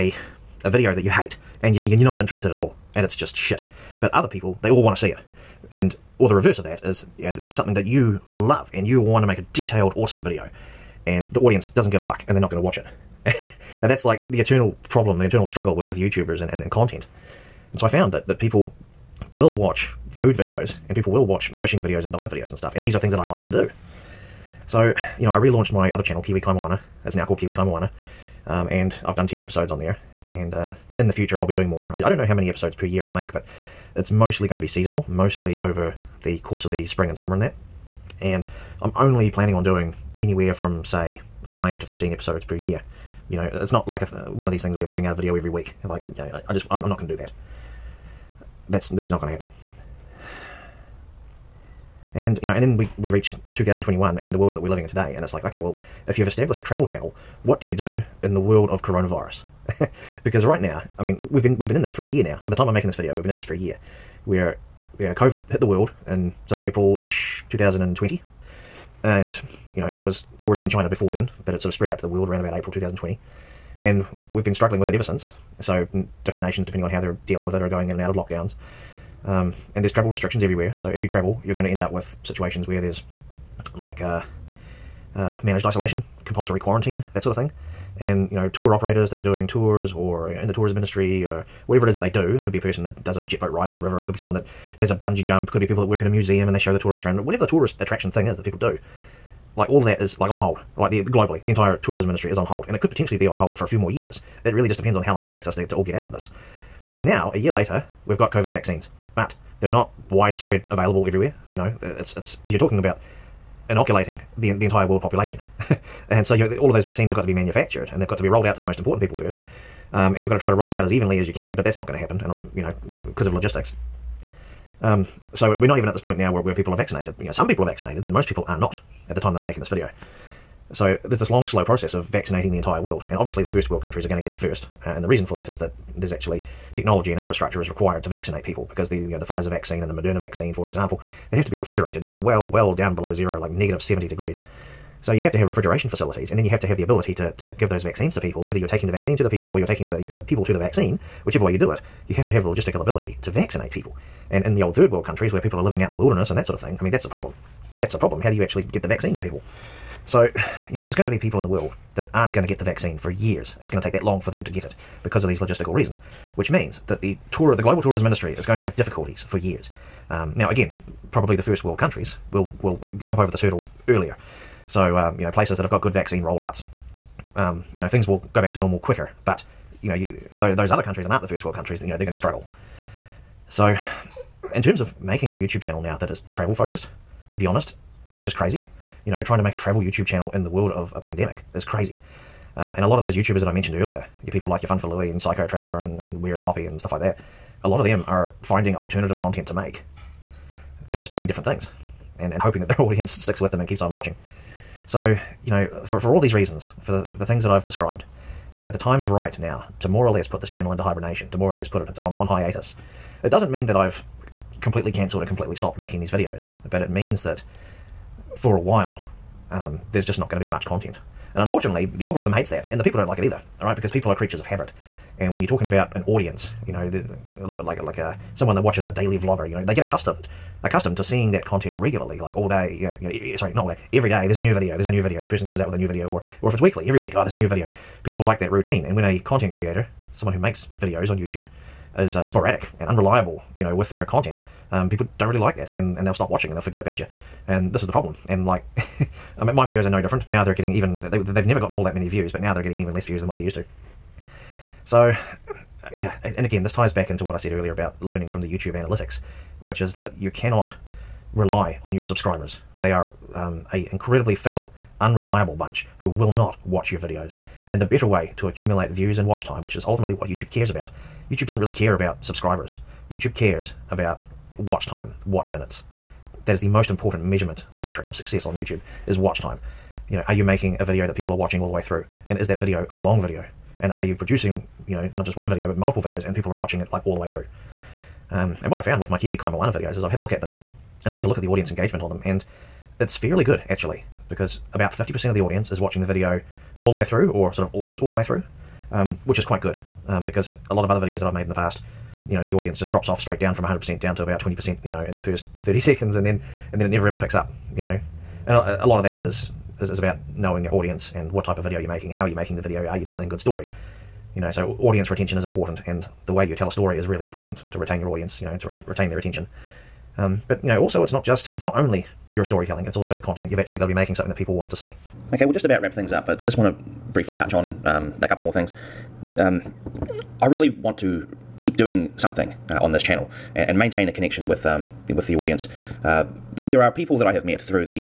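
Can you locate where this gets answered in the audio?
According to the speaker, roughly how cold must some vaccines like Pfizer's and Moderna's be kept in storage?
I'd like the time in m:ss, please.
2:23.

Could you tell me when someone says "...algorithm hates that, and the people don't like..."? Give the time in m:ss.
3:42.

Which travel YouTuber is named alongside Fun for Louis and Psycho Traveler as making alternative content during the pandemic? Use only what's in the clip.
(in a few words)
Where is Poppy.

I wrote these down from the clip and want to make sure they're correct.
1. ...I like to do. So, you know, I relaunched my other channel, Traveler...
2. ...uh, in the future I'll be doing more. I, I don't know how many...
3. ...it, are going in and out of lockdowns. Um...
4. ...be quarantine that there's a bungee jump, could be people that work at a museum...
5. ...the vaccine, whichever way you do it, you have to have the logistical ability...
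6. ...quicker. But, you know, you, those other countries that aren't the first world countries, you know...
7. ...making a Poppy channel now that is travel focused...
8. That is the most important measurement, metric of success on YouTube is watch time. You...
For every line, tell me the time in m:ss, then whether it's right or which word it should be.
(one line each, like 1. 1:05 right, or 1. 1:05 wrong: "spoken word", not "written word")
1. 0:23 wrong: "Kiwi", not "Traveler"
2. 0:30 right
3. 1:17 right
4. 1:34 wrong: "someone", not "quarantine"
5. 2:30 right
6. 2:58 right
7. 3:04 wrong: "YouTube", not "Poppy"
8. 4:36 right.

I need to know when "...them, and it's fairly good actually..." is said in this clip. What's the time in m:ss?
4:52.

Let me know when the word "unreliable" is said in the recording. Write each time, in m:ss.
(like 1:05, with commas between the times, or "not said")
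4:02, 4:24.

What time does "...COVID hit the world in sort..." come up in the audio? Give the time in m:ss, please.
1:05.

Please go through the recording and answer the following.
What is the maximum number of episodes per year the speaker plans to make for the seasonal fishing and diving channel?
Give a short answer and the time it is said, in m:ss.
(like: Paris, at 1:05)
15, at 0:41.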